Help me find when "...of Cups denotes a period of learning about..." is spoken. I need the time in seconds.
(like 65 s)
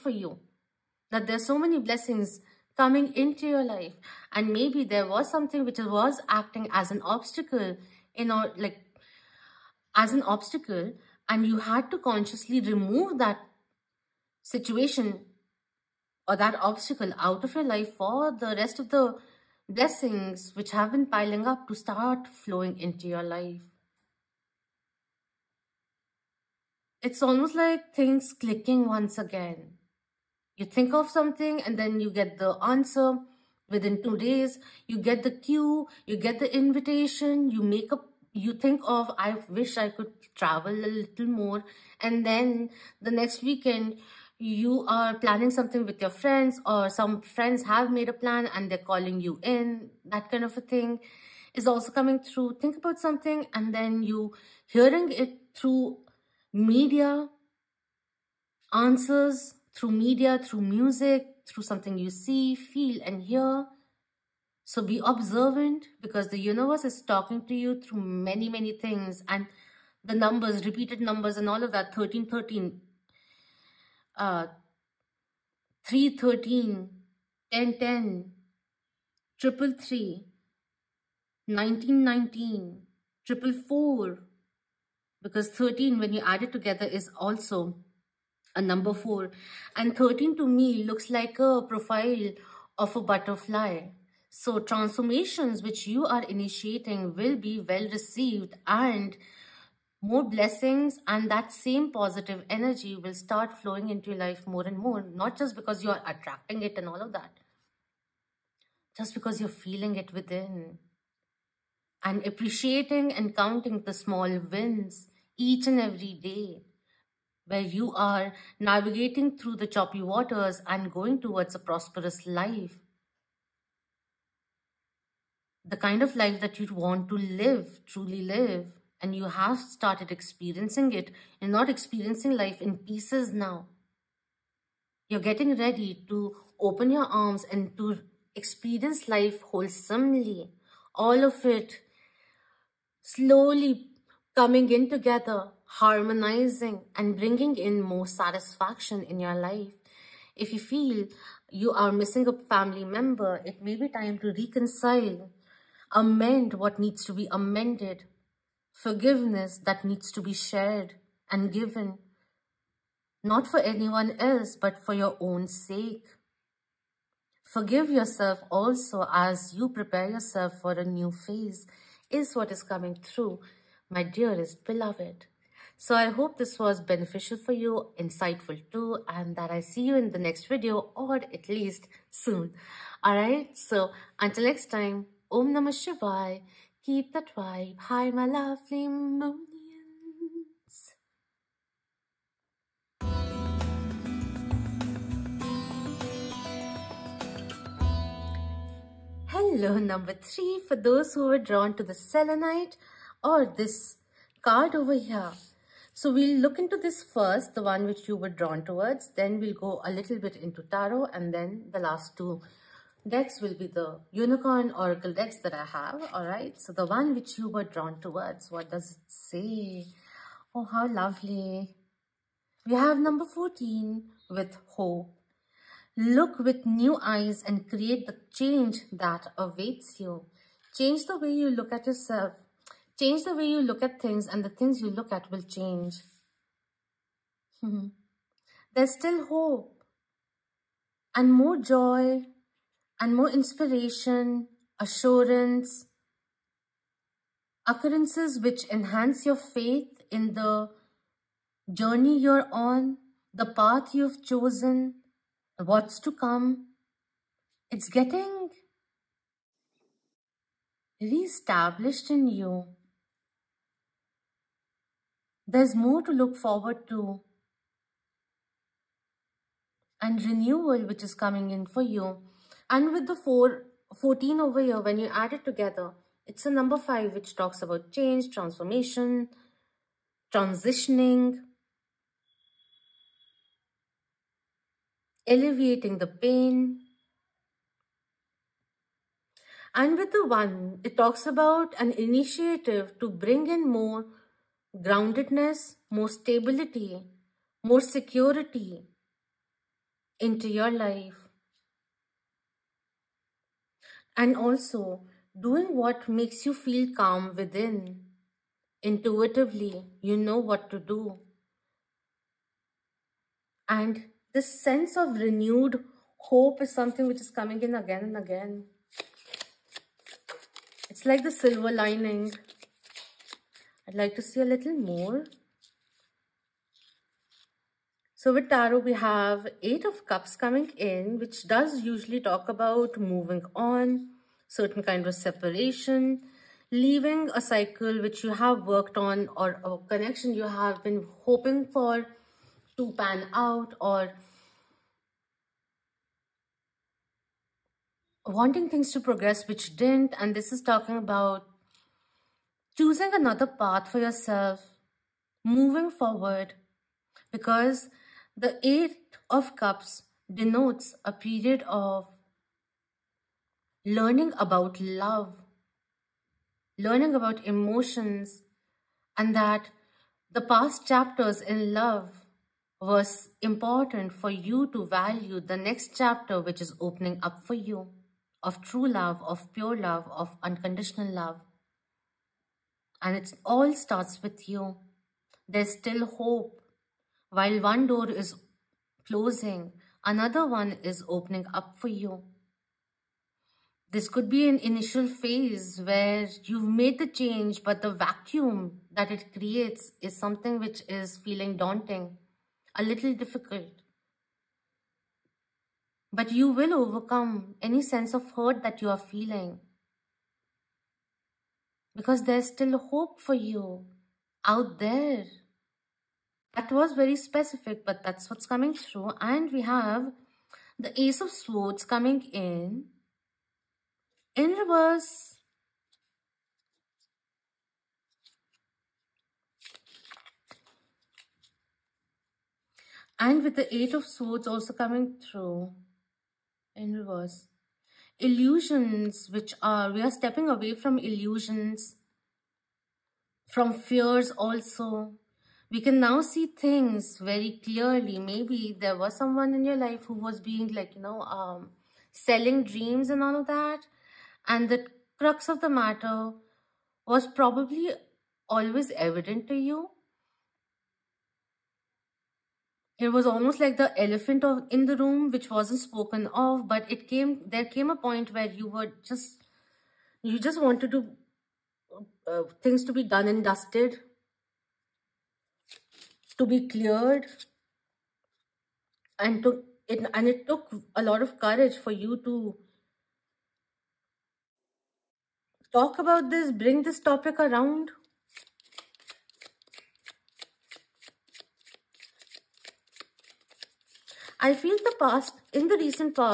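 359 s.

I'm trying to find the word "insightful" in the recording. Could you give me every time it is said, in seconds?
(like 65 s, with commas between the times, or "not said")
177 s.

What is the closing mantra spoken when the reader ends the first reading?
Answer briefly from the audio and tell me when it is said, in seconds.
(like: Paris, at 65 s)
Om Namah Shivaya, at 185 s.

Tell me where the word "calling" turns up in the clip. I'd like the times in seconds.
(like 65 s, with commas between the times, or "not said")
48 s.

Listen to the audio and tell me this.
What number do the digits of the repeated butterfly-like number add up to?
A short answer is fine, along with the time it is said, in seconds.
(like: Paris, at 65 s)
4, at 88 s.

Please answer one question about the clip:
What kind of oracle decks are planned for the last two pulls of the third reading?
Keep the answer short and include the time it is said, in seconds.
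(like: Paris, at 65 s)
unicorn oracle decks, at 214 s.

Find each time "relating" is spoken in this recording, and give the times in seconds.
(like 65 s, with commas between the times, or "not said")
not said.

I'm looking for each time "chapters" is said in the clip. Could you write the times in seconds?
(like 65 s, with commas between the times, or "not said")
370 s, 375 s.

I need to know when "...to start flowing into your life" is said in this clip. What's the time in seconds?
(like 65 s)
21 s.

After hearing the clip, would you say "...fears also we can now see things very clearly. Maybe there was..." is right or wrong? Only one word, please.
right.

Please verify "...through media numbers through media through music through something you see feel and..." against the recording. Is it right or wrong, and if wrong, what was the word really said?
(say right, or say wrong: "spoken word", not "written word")
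wrong: "answers", not "numbers".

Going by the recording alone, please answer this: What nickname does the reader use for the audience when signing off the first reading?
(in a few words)
moonians.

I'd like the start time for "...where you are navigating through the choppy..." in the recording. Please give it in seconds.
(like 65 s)
117 s.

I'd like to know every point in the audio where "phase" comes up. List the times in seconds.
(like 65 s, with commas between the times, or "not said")
171 s, 395 s.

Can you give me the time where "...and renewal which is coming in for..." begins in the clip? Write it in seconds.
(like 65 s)
270 s.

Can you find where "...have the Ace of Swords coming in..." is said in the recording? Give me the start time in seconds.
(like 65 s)
419 s.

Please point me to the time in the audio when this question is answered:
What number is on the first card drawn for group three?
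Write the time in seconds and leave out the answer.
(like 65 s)
222 s.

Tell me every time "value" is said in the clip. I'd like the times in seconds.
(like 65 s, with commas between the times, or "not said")
374 s.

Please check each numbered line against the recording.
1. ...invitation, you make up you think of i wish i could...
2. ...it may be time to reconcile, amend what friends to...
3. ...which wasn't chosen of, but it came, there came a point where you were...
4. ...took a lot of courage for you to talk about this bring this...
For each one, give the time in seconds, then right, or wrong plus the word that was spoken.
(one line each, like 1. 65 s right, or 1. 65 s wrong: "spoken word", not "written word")
1. 36 s right
2. 153 s wrong: "needs", not "friends"
3. 465 s wrong: "spoken", not "chosen"
4. 480 s right.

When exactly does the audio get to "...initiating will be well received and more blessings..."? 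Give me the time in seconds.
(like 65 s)
96 s.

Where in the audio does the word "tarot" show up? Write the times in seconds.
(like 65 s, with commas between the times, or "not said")
210 s, 328 s.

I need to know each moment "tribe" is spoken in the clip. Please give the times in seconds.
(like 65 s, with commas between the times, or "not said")
187 s.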